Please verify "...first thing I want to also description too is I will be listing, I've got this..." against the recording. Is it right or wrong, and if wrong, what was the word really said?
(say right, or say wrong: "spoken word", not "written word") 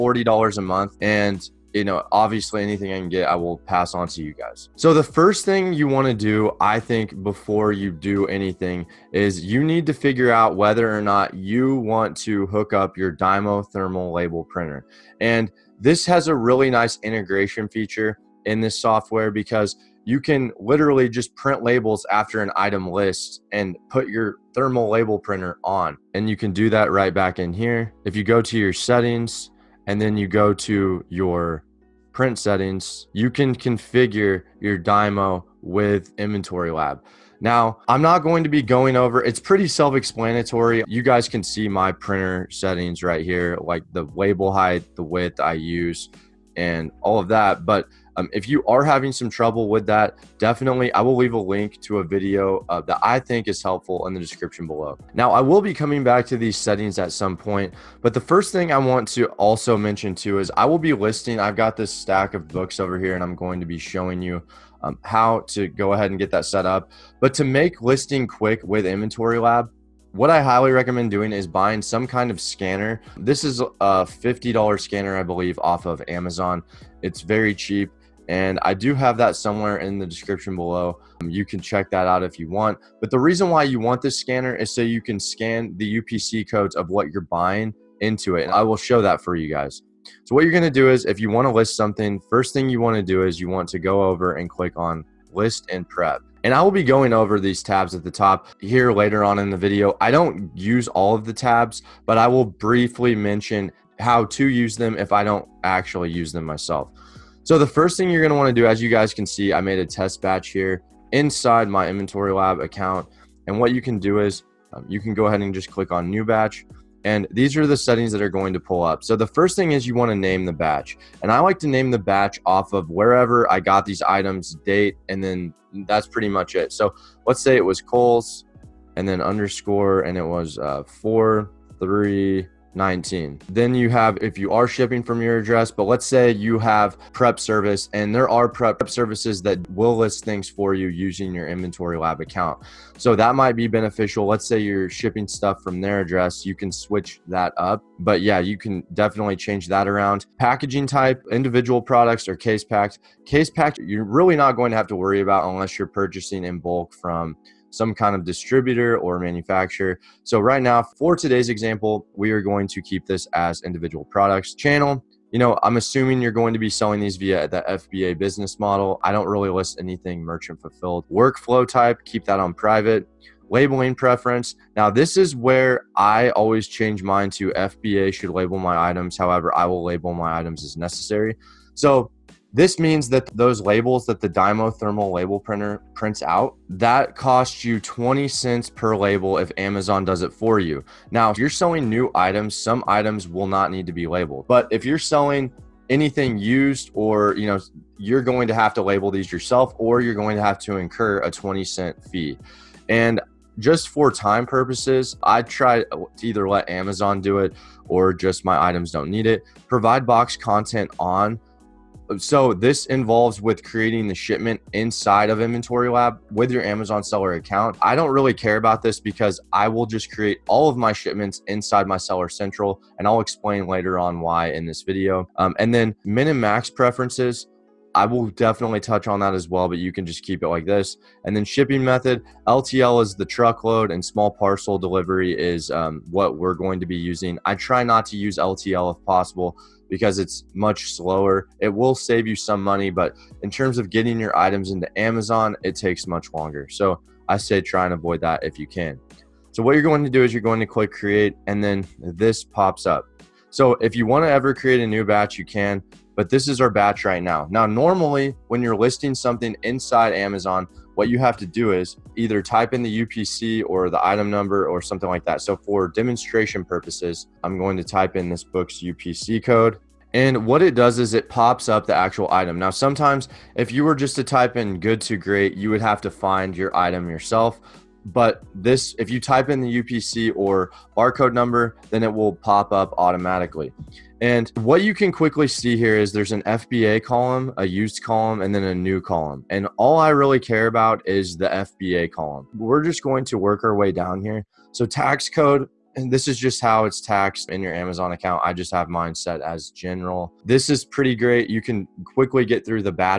wrong: "mention", not "description".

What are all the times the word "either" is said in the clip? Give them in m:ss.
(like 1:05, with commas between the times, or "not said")
3:26, 4:22.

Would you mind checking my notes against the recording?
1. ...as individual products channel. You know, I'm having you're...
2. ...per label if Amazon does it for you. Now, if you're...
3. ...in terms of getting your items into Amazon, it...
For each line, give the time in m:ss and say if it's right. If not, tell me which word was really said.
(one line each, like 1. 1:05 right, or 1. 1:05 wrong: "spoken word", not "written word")
1. 2:43 wrong: "assuming", not "having"
2. 3:08 right
3. 4:03 right.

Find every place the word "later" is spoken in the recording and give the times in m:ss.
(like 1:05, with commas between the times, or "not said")
1:38, 3:43.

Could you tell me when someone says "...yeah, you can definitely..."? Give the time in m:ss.
2:28.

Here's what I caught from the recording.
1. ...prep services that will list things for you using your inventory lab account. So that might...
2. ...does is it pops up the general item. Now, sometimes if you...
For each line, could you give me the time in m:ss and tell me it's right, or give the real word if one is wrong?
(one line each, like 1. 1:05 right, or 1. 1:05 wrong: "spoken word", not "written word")
1. 2:18 right
2. 4:30 wrong: "actual", not "general".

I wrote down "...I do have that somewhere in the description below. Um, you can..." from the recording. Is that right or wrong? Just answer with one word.
right.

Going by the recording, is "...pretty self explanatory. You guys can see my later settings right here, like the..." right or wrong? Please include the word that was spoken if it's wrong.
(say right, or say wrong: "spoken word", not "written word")
wrong: "printer", not "later".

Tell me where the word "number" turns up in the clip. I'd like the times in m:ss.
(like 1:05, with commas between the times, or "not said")
4:24, 4:41.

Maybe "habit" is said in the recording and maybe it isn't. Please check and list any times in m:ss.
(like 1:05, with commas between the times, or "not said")
not said.